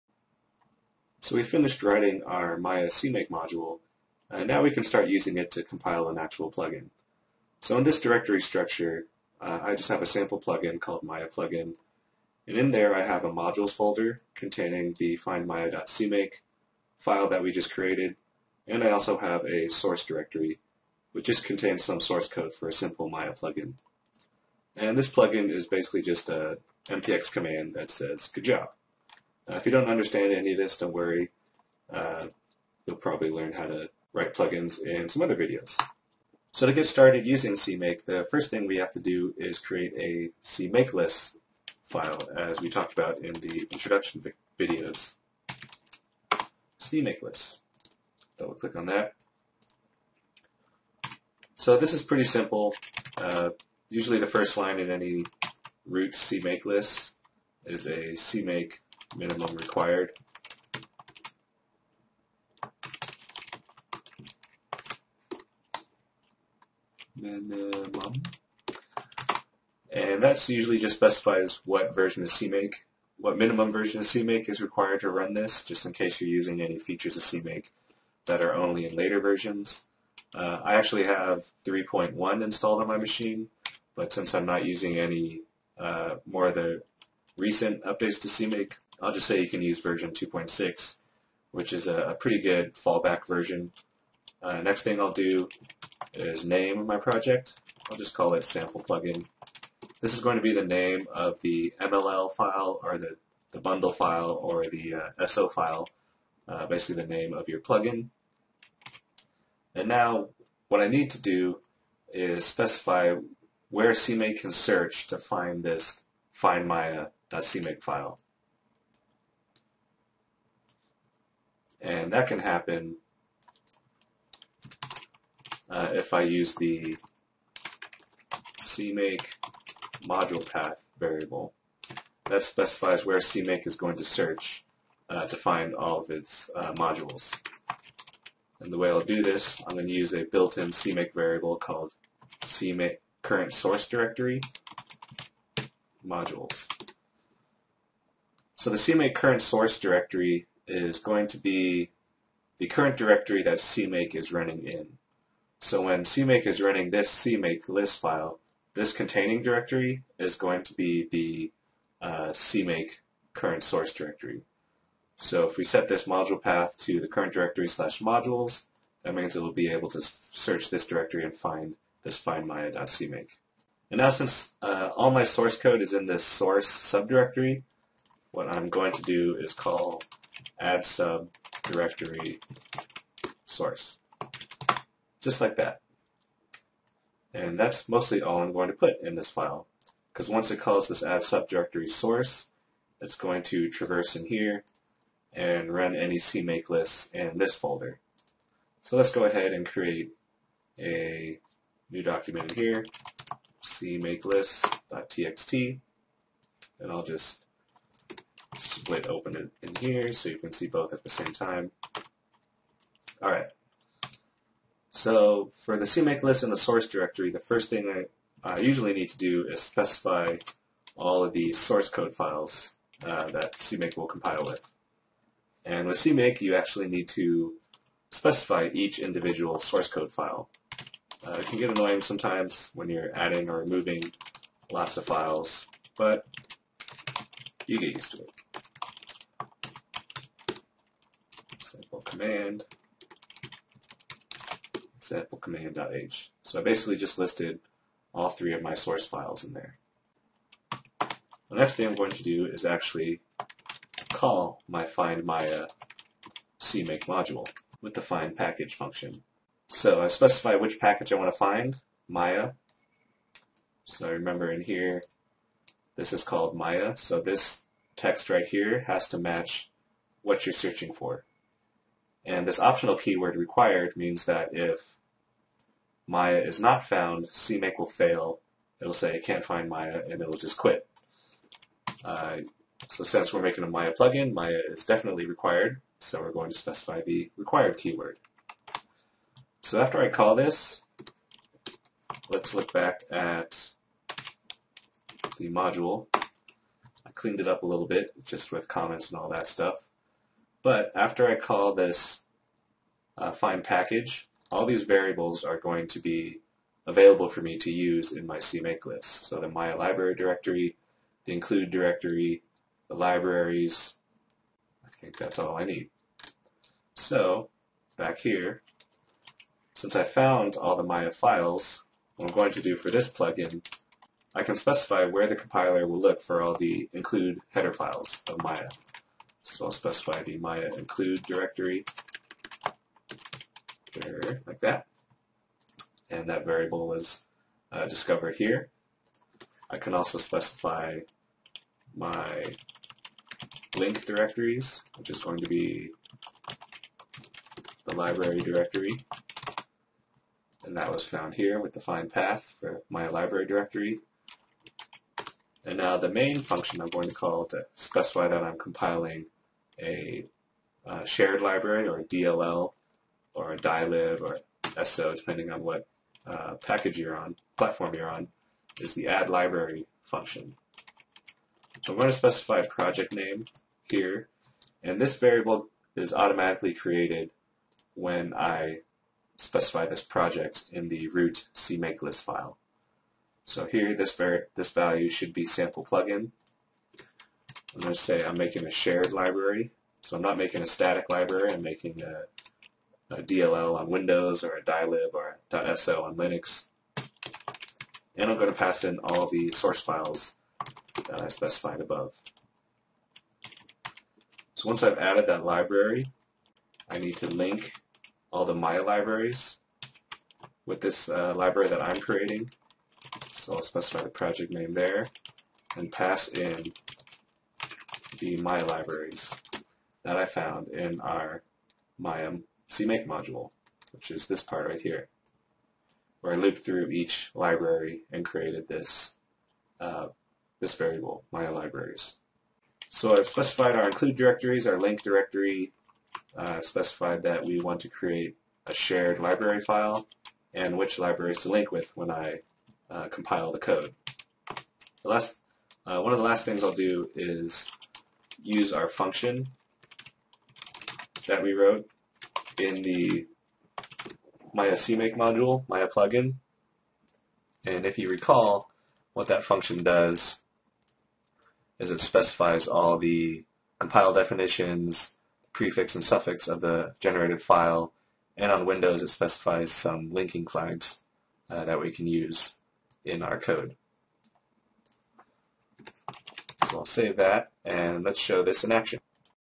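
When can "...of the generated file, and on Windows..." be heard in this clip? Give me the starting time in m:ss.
7:46.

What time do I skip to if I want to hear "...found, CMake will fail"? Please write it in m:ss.
4:36.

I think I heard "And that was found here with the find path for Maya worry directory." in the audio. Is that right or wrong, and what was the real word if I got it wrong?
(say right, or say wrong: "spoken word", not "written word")
wrong: "library", not "worry".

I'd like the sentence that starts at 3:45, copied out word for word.
And with CMake, you actually need to specify each individual source code file.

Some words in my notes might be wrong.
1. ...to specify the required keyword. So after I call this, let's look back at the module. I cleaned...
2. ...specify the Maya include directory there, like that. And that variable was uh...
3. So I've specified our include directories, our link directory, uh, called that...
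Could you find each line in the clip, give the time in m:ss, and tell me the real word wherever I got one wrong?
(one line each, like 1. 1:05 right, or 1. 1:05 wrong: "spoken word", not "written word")
1. 4:46 right
2. 5:29 right
3. 7:12 wrong: "specified", not "called".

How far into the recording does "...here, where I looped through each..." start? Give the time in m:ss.
7:04.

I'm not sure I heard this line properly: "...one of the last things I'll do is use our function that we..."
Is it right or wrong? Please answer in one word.
right.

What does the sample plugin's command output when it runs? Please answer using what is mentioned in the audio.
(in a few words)
Good job.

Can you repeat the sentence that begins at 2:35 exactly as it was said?
So when CMake is running this CMake list file, this containing directory is going to be the uh, CMake current source directory.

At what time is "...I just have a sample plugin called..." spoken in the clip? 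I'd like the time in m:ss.
0:09.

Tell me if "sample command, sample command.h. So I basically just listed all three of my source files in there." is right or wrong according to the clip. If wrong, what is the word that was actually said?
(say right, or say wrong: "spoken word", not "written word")
right.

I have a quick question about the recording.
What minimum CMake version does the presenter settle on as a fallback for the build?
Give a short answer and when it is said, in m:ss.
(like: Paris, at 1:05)
2.6, at 1:30.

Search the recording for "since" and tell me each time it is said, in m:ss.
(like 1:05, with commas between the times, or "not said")
1:24, 2:54, 4:43, 5:19.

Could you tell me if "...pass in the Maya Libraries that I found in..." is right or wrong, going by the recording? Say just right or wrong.
right.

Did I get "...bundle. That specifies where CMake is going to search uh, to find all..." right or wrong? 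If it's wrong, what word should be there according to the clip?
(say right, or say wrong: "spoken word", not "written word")
wrong: "variable", not "bundle".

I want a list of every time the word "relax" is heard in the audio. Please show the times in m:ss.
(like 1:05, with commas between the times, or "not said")
not said.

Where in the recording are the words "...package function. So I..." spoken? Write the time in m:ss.
4:18.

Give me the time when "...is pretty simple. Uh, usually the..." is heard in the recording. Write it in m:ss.
0:51.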